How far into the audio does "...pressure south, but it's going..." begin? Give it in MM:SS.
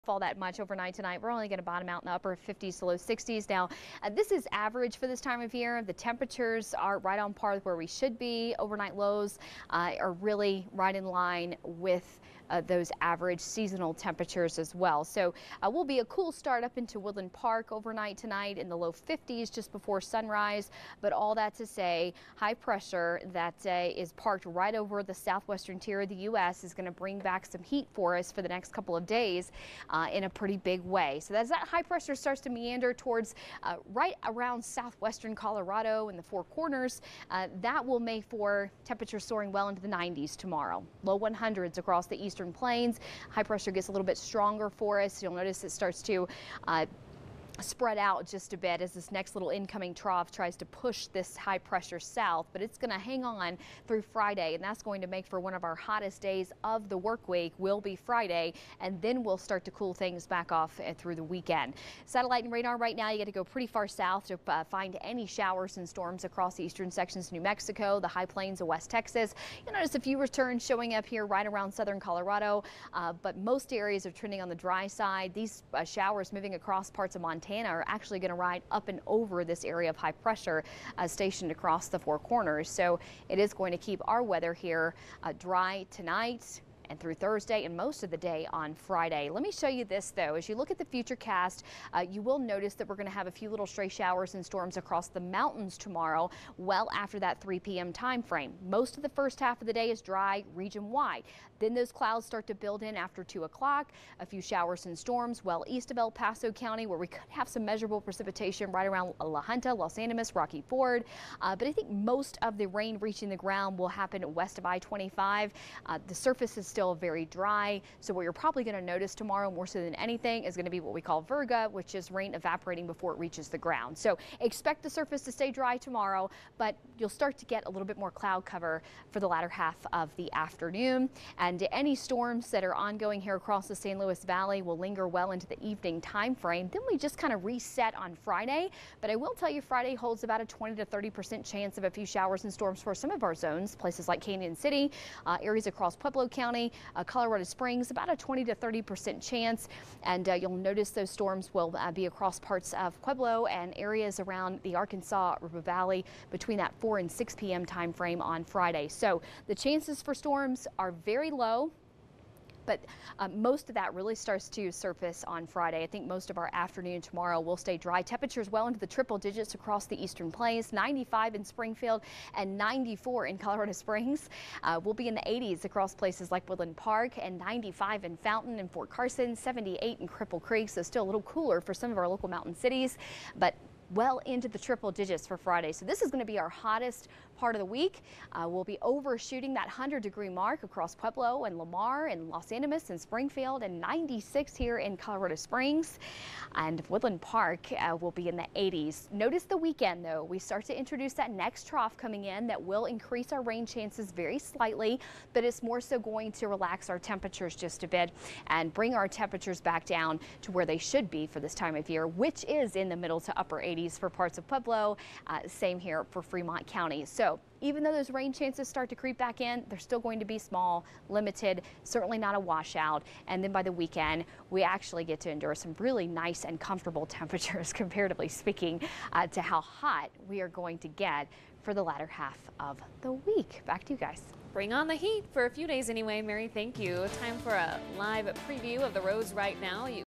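00:51.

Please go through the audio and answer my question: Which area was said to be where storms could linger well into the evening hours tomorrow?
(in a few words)
San Luis Valley.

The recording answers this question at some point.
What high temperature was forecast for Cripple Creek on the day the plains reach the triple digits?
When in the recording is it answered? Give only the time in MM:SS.
02:59.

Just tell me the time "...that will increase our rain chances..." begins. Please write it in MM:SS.
03:22.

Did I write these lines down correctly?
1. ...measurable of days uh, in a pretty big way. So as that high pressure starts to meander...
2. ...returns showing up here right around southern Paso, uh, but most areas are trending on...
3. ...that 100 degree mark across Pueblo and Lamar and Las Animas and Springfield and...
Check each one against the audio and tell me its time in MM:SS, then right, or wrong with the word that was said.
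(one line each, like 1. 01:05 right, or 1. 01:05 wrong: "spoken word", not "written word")
1. 00:28 wrong: "couple", not "measurable"
2. 01:10 wrong: "Colorado", not "Paso"
3. 03:09 right.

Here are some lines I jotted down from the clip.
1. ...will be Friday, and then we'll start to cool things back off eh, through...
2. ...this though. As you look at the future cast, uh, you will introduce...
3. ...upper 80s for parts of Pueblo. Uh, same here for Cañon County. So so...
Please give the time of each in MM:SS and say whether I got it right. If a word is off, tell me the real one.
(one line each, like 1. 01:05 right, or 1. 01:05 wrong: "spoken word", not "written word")
1. 00:57 right
2. 01:29 wrong: "notice", not "introduce"
3. 03:33 wrong: "Fremont", not "Cañon".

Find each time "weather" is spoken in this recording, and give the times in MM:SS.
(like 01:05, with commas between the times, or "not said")
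01:24.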